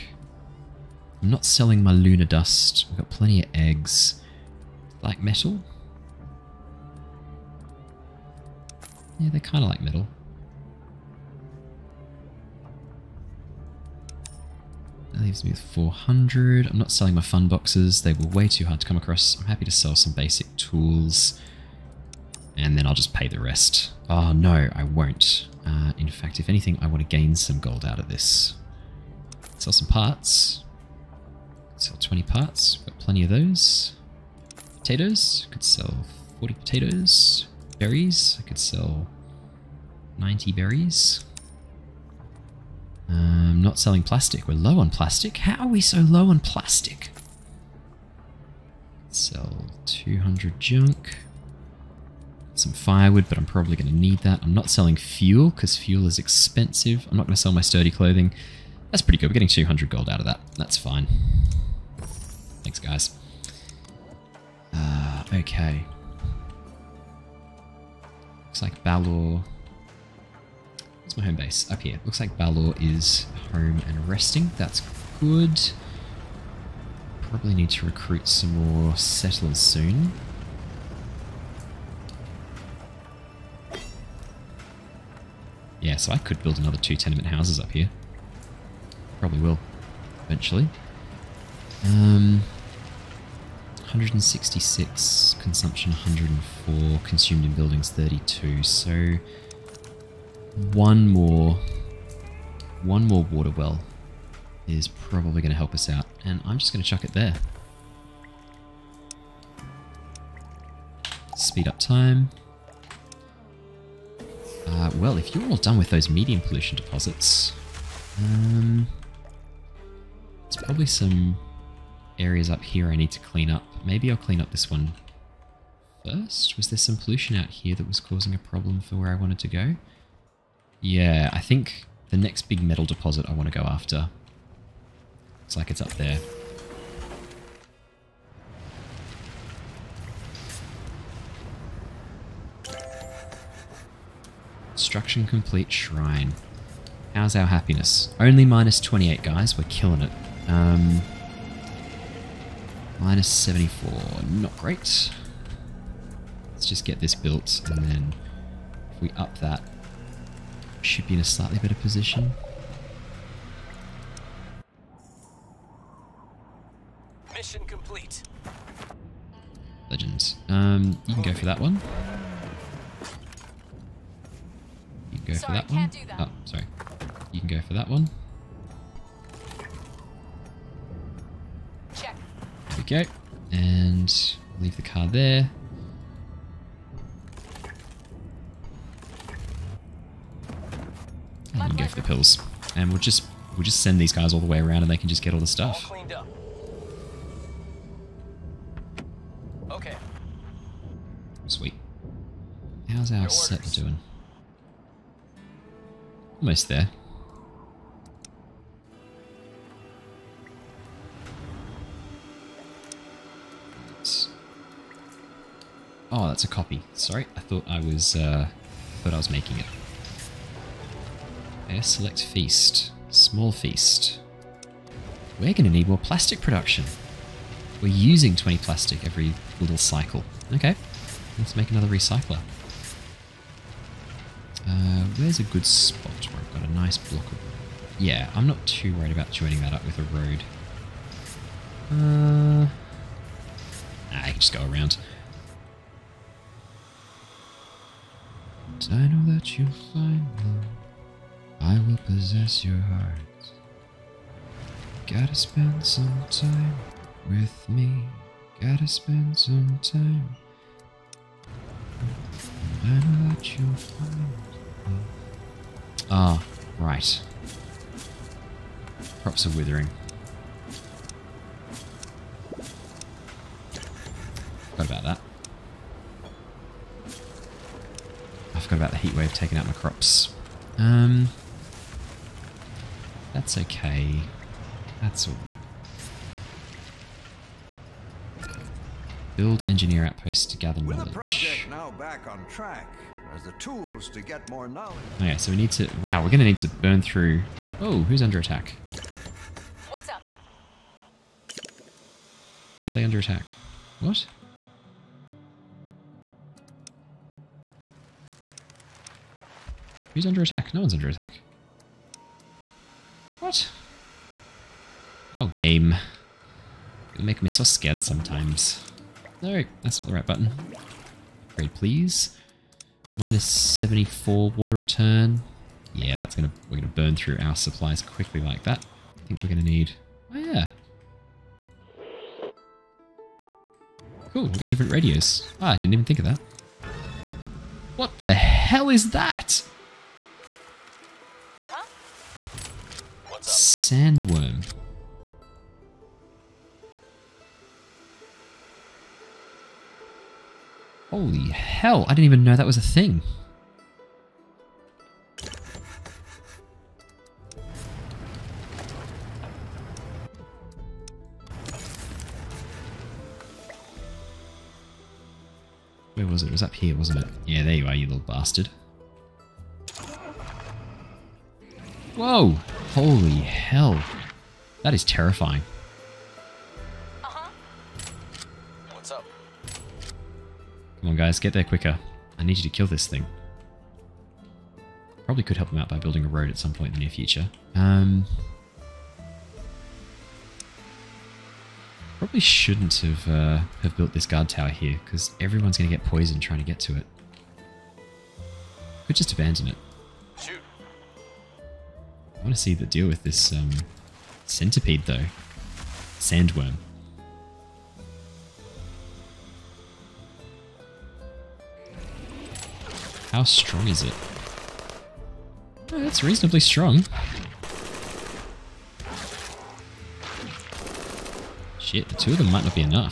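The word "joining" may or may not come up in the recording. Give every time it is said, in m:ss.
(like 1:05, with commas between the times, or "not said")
3:59.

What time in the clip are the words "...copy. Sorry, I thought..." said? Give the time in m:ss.
3:36.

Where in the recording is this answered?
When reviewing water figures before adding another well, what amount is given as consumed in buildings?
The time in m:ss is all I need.
1:37.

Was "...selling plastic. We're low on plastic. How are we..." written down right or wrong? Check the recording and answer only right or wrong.
right.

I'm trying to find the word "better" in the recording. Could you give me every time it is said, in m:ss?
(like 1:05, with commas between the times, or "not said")
2:41.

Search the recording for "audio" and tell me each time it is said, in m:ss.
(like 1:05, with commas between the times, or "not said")
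not said.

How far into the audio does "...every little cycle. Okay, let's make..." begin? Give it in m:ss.
3:49.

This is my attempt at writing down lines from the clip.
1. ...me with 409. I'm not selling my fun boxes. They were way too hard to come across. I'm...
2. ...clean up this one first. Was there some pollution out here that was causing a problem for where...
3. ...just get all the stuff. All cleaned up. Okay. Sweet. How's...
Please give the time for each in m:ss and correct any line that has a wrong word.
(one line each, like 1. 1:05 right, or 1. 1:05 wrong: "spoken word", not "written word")
1. 0:15 wrong: "400", not "409"
2. 2:04 right
3. 3:15 right.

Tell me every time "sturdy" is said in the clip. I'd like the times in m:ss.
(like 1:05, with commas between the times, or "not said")
0:57.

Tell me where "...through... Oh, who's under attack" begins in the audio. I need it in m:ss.
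4:57.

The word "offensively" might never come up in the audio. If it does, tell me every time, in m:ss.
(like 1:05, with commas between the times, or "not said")
not said.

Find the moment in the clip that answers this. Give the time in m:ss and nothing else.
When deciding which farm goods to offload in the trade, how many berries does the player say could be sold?
0:40.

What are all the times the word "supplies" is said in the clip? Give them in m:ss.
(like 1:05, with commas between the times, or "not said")
5:27.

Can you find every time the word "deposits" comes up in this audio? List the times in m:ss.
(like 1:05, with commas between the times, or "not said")
1:56, 2:12.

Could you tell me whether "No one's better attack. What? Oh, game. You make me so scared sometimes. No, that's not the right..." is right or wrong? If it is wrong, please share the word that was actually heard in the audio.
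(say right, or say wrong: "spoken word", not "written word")
wrong: "under", not "better".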